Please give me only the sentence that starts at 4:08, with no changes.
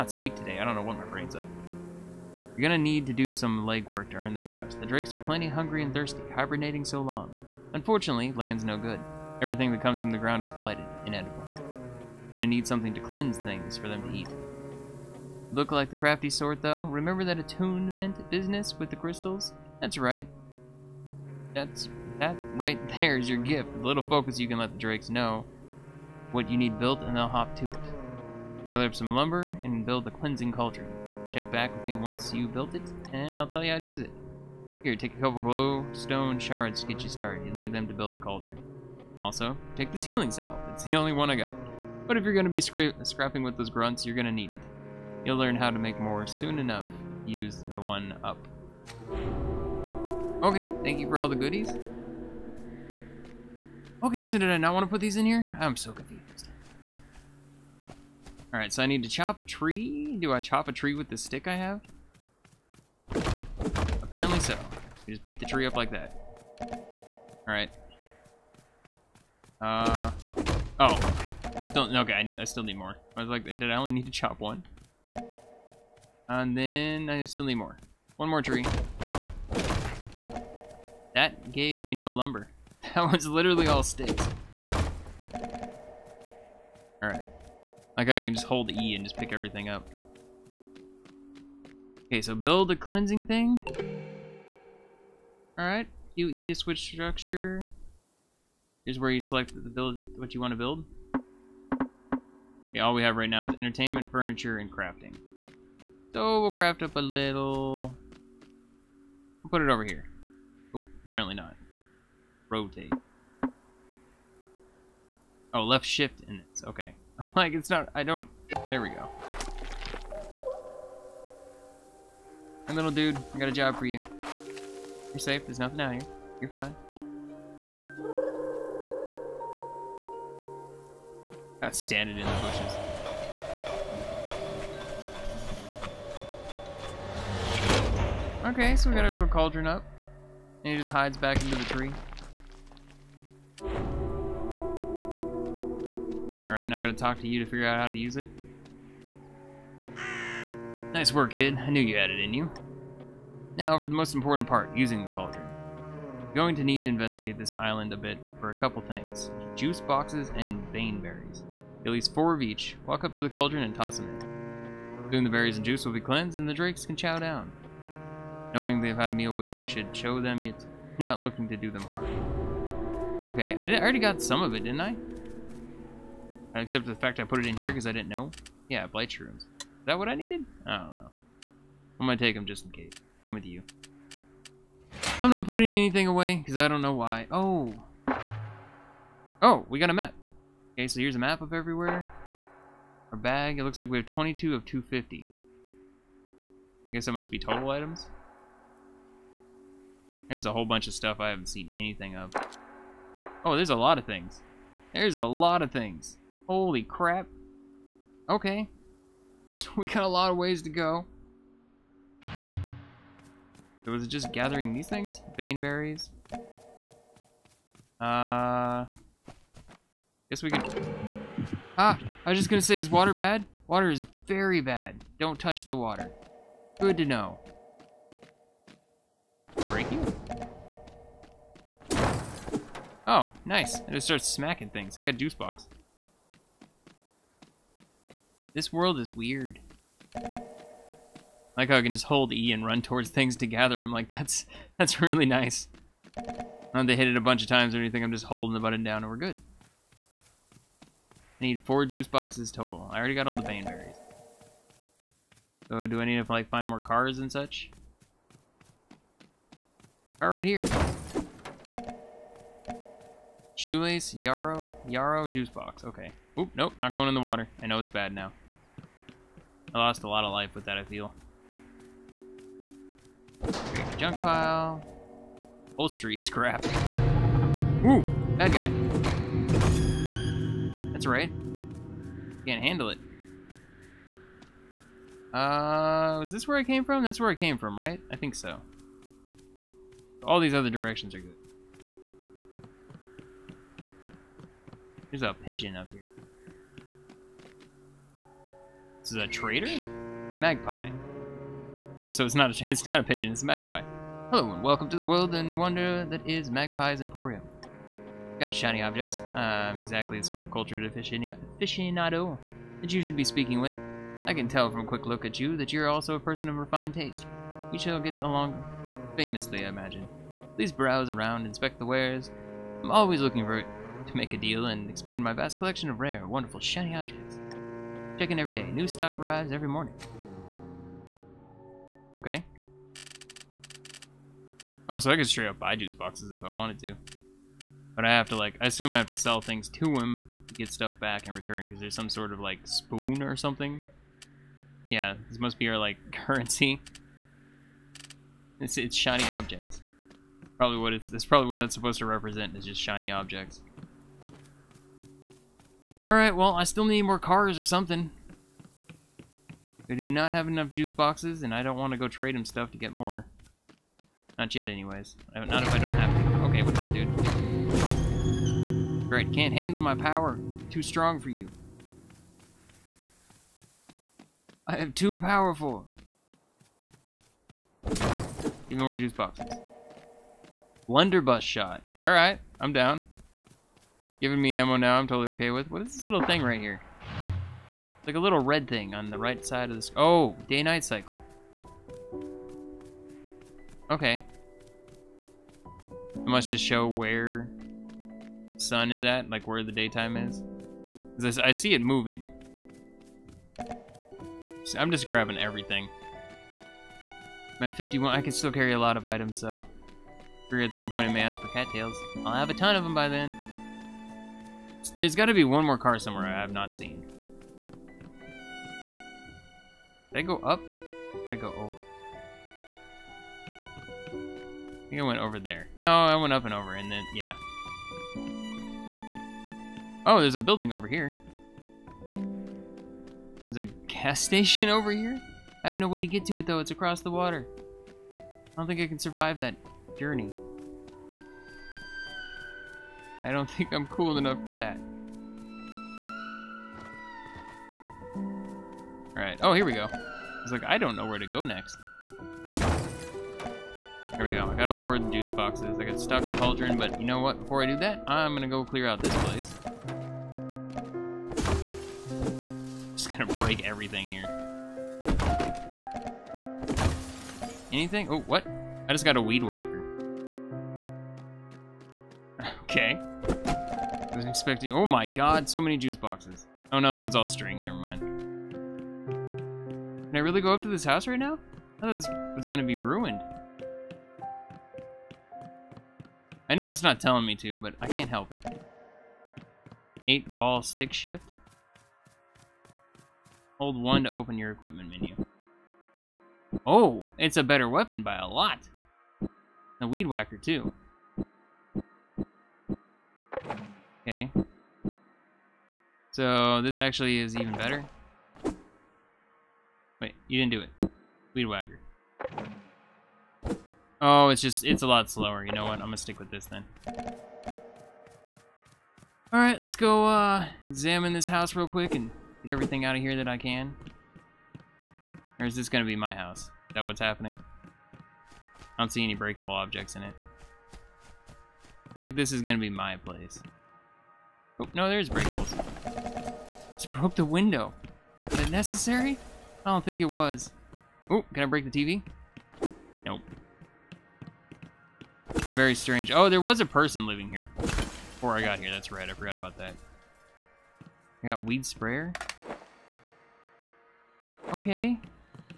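I'm just holding the button down and we're good.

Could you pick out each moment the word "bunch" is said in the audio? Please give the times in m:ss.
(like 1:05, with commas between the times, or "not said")
3:20, 4:07.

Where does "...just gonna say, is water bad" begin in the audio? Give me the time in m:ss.
3:42.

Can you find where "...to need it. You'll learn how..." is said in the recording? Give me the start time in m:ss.
0:44.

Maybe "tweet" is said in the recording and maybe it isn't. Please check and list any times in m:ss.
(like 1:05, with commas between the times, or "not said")
not said.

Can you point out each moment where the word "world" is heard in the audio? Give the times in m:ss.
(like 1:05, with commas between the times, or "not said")
3:58, 5:05.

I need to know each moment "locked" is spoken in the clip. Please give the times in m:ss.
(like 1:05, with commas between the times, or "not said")
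not said.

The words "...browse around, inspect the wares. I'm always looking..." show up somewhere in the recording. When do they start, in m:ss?
5:20.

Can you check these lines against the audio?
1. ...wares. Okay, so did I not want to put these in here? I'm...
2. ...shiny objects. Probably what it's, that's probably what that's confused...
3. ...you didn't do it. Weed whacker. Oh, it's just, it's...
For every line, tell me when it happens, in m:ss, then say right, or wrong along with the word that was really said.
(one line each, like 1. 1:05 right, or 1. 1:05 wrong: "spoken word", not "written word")
1. 0:51 wrong: "goodies", not "wares"
2. 5:48 wrong: "supposed", not "confused"
3. 8:30 right.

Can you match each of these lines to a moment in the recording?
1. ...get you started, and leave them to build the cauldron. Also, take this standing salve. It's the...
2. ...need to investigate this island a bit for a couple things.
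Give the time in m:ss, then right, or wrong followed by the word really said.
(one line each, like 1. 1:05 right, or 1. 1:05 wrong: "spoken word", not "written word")
1. 0:36 wrong: "healing", not "standing"
2. 2:36 right.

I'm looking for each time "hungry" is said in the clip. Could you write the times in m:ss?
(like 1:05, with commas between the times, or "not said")
0:05.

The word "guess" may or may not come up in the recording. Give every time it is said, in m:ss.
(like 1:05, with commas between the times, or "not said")
3:16, 3:40.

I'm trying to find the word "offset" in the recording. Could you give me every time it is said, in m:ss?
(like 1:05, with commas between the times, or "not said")
not said.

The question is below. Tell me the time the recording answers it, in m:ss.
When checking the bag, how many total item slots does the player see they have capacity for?
3:14.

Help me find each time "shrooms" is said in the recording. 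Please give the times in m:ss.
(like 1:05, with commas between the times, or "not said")
2:59.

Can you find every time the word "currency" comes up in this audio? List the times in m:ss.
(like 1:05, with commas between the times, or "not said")
5:46.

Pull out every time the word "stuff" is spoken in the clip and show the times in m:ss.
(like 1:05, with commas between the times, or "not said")
3:20, 5:40, 6:02.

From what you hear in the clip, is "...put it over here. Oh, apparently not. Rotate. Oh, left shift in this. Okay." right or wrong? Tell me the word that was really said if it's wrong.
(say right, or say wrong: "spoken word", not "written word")
right.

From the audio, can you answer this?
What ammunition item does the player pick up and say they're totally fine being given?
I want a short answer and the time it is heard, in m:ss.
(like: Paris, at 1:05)
Blunderbuss shot, at 6:20.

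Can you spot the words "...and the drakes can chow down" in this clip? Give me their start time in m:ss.
2:46.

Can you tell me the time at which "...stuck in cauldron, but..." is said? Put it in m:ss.
7:36.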